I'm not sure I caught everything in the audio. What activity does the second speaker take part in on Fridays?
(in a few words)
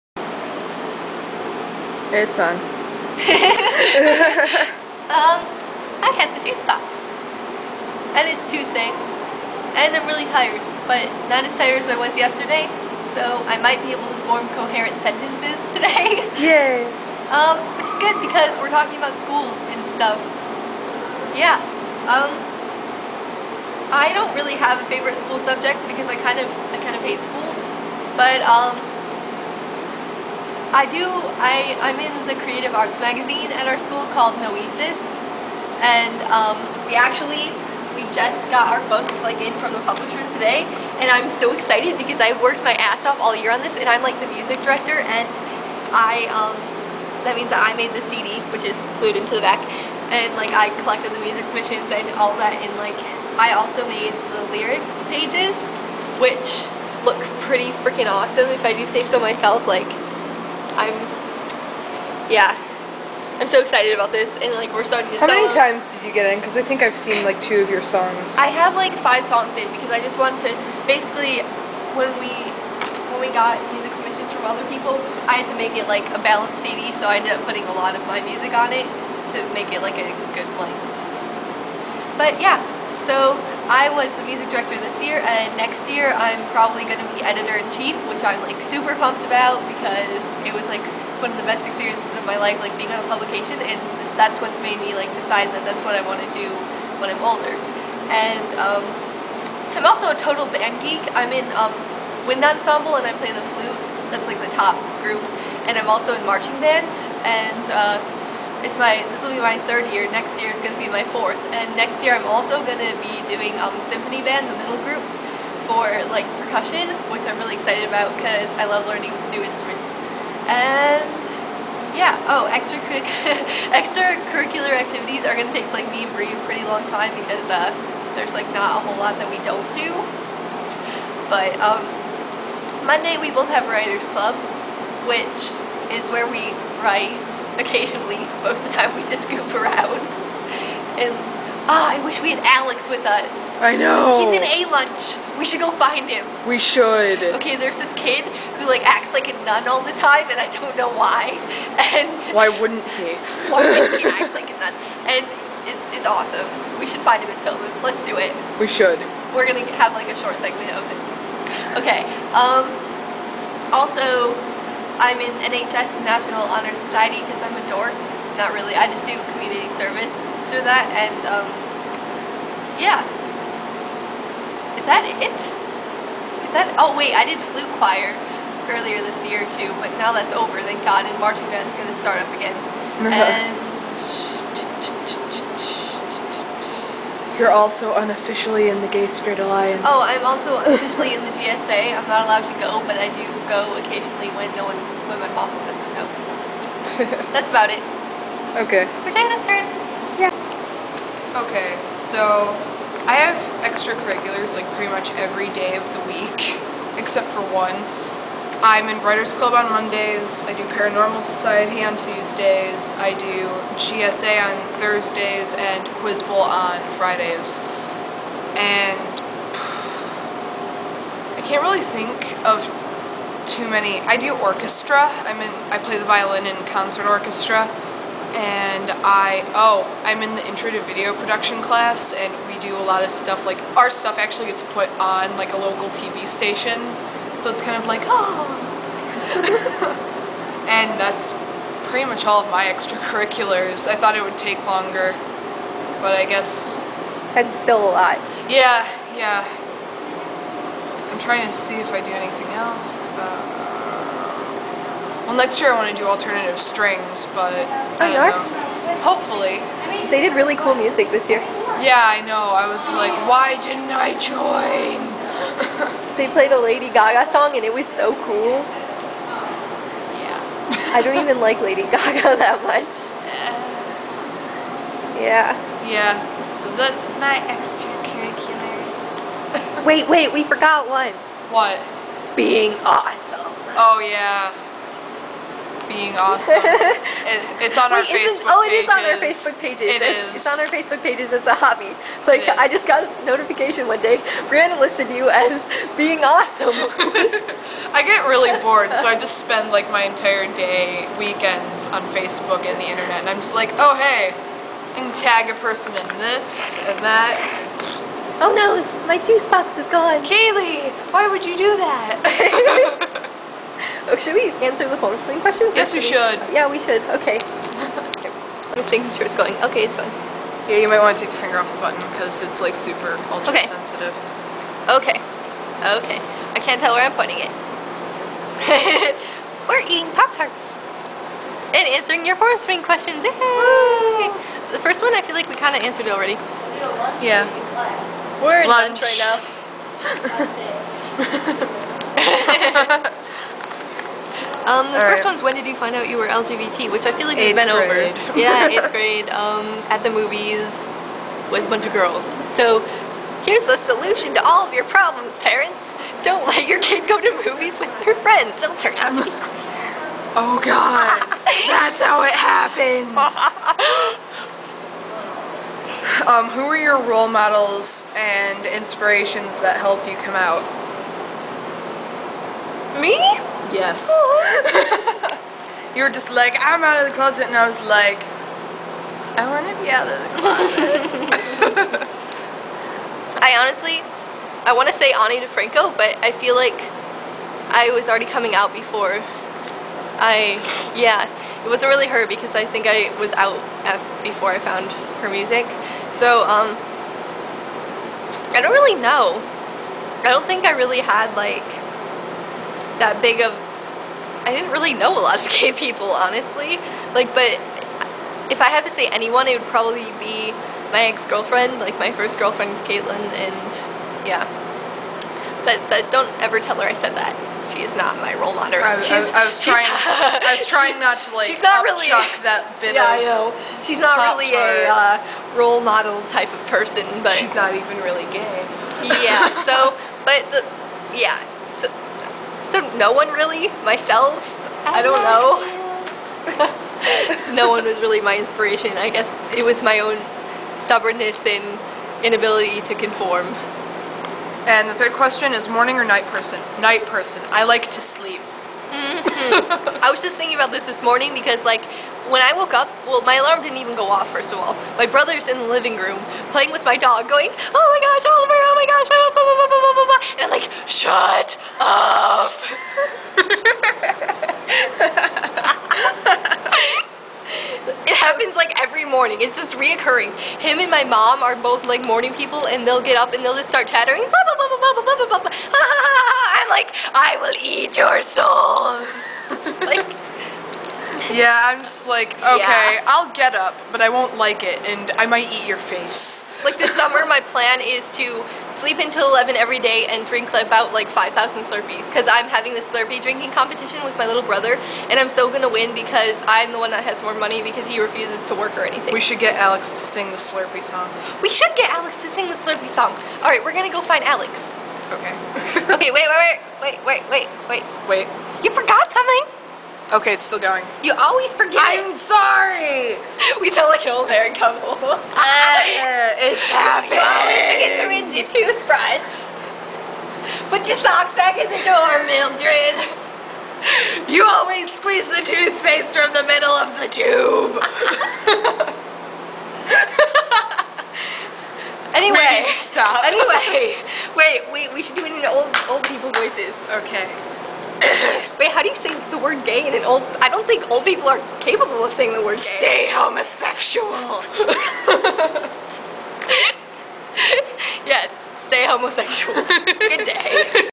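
Quiz Bowl.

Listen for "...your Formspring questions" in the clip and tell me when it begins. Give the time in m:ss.
5:32.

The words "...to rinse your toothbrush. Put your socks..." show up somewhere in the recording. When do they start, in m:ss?
8:37.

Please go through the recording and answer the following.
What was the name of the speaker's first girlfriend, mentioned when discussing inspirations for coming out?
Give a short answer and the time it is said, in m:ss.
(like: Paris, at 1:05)
Caitlin, at 6:52.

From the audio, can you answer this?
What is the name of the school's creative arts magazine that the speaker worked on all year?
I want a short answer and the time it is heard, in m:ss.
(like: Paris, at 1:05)
Noesis, at 0:34.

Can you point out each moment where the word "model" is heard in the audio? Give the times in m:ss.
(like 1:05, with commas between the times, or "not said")
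6:07, 6:58, 7:05.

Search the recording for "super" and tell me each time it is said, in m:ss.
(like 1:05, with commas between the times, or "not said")
1:28, 5:22.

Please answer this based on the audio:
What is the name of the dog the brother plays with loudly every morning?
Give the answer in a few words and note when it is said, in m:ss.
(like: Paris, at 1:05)
Oliver, at 7:38.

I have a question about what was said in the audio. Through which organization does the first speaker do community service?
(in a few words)
National Honor Society.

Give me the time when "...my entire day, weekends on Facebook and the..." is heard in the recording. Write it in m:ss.
4:59.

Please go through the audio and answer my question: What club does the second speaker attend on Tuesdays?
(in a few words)
Paranormal Society.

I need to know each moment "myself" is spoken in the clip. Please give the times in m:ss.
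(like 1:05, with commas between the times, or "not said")
0:59, 7:13.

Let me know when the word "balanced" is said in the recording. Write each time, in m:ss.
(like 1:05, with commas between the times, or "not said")
1:16.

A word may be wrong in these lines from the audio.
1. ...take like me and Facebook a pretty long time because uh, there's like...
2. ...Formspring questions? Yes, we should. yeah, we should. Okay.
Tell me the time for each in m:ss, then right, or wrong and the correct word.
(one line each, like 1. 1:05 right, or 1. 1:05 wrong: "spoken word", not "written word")
1. 2:05 wrong: "Brie", not "Facebook"
2. 5:14 right.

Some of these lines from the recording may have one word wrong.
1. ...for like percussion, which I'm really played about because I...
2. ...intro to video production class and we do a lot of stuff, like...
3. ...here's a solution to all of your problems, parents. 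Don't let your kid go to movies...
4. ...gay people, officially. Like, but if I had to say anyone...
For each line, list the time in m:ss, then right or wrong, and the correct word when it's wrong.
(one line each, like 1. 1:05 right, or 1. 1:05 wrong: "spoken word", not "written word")
1. 1:55 wrong: "excited", not "played"
2. 3:50 right
3. 5:53 right
4. 6:45 wrong: "honestly", not "officially".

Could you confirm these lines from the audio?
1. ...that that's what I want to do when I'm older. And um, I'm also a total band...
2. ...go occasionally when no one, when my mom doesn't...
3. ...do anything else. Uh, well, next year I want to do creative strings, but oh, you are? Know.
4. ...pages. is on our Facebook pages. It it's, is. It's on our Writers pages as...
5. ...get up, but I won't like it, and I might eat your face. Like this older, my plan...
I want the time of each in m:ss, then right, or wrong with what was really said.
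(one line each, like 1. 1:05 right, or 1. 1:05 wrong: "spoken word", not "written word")
1. 1:35 right
2. 3:13 right
3. 4:12 wrong: "alternative", not "creative"
4. 4:48 wrong: "Facebook", not "Writers"
5. 8:03 wrong: "summer", not "older".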